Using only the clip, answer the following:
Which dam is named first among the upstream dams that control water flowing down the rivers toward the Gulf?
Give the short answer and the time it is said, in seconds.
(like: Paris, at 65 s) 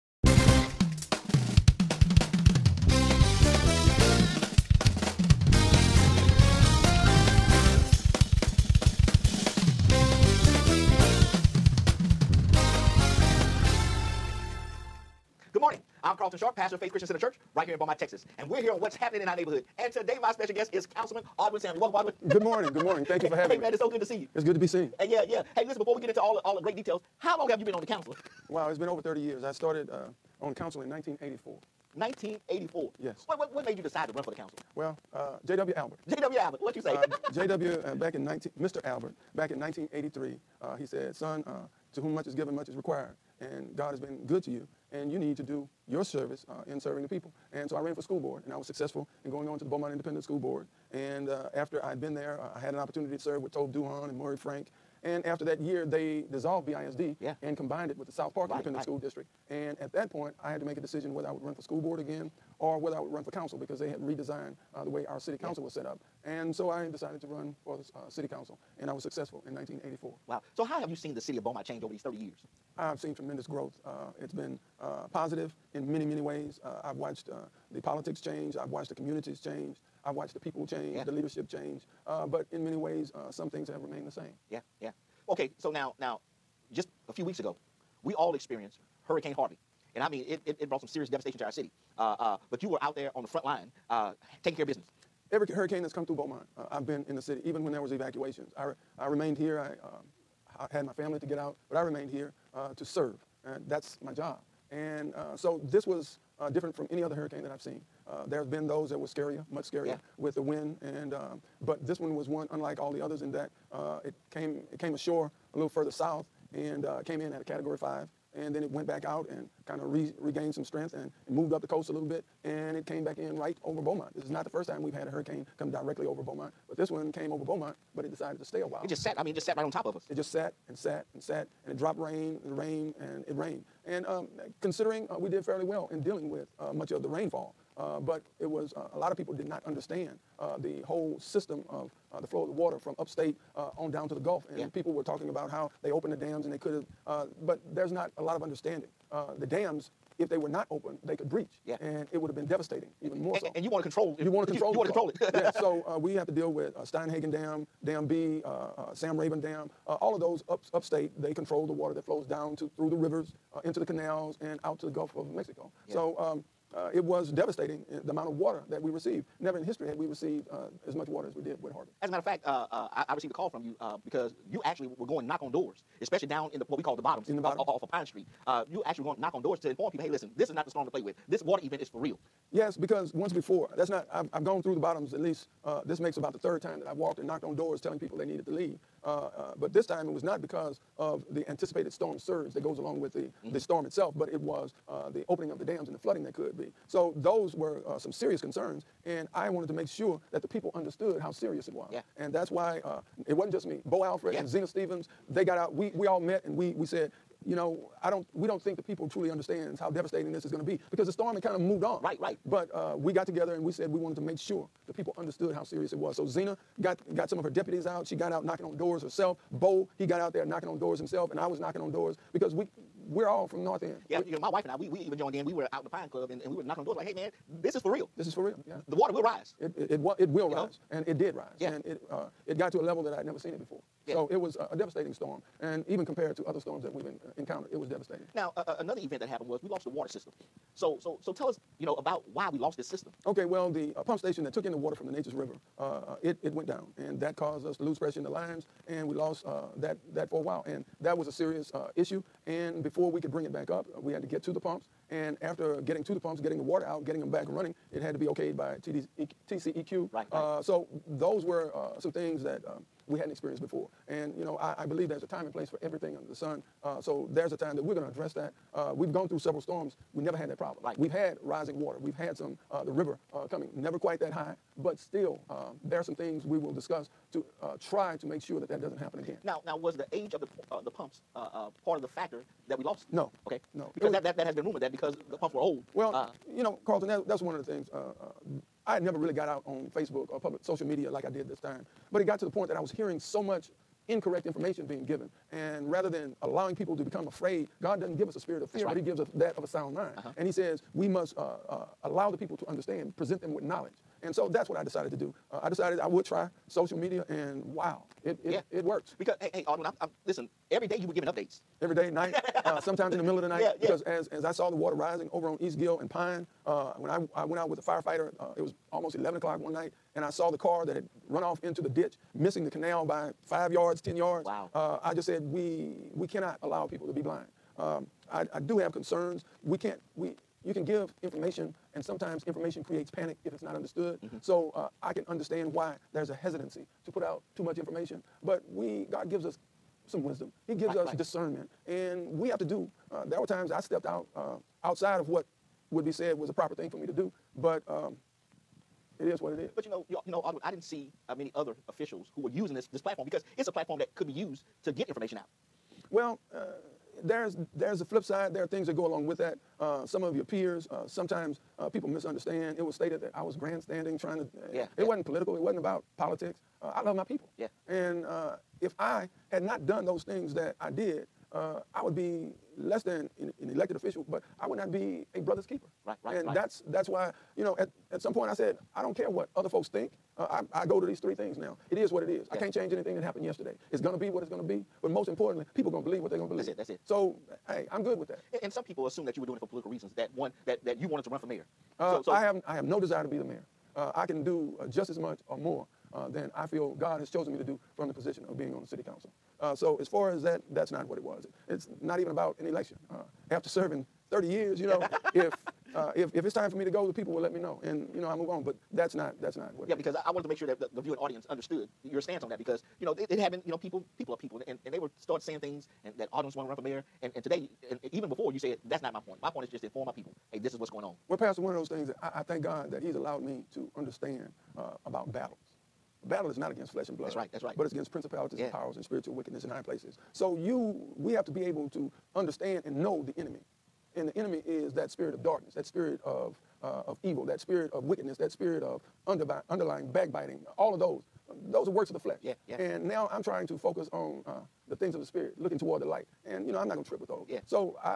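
Steinhagen Dam, at 156 s.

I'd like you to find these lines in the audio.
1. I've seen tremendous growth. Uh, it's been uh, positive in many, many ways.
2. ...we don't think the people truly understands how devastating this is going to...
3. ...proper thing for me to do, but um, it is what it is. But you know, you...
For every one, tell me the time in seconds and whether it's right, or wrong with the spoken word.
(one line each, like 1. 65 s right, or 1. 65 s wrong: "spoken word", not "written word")
1. 72 s right
2. 208 s right
3. 346 s right.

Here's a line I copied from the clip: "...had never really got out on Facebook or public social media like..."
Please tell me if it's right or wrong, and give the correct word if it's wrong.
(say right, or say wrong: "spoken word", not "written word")
right.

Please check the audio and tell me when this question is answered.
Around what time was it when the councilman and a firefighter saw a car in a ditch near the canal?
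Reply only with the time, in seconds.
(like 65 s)
319 s.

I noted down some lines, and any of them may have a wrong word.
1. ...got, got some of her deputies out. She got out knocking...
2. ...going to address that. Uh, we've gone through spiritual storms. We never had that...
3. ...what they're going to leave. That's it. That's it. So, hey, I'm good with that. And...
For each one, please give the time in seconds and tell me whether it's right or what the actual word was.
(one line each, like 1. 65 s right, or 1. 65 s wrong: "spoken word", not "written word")
1. 216 s right
2. 267 s wrong: "several", not "spiritual"
3. 386 s wrong: "believe", not "leave".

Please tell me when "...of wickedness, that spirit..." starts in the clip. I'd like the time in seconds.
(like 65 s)
437 s.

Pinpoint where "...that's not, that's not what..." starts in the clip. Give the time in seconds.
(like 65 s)
408 s.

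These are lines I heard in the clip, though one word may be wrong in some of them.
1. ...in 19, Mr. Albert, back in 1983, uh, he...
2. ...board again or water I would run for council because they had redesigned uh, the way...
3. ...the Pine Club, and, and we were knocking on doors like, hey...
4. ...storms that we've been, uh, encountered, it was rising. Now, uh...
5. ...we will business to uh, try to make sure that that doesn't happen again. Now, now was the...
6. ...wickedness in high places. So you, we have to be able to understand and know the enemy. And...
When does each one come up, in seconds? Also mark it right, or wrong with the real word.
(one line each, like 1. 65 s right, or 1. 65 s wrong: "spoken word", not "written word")
1. 38 s right
2. 61 s wrong: "whether", not "water"
3. 225 s right
4. 236 s wrong: "devastating", not "rising"
5. 276 s wrong: "discuss", not "business"
6. 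429 s right.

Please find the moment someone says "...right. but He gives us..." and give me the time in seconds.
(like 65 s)
298 s.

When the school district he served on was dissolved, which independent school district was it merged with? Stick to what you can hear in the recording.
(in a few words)
South Park.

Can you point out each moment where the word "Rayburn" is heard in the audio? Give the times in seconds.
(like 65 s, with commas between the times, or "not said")
159 s.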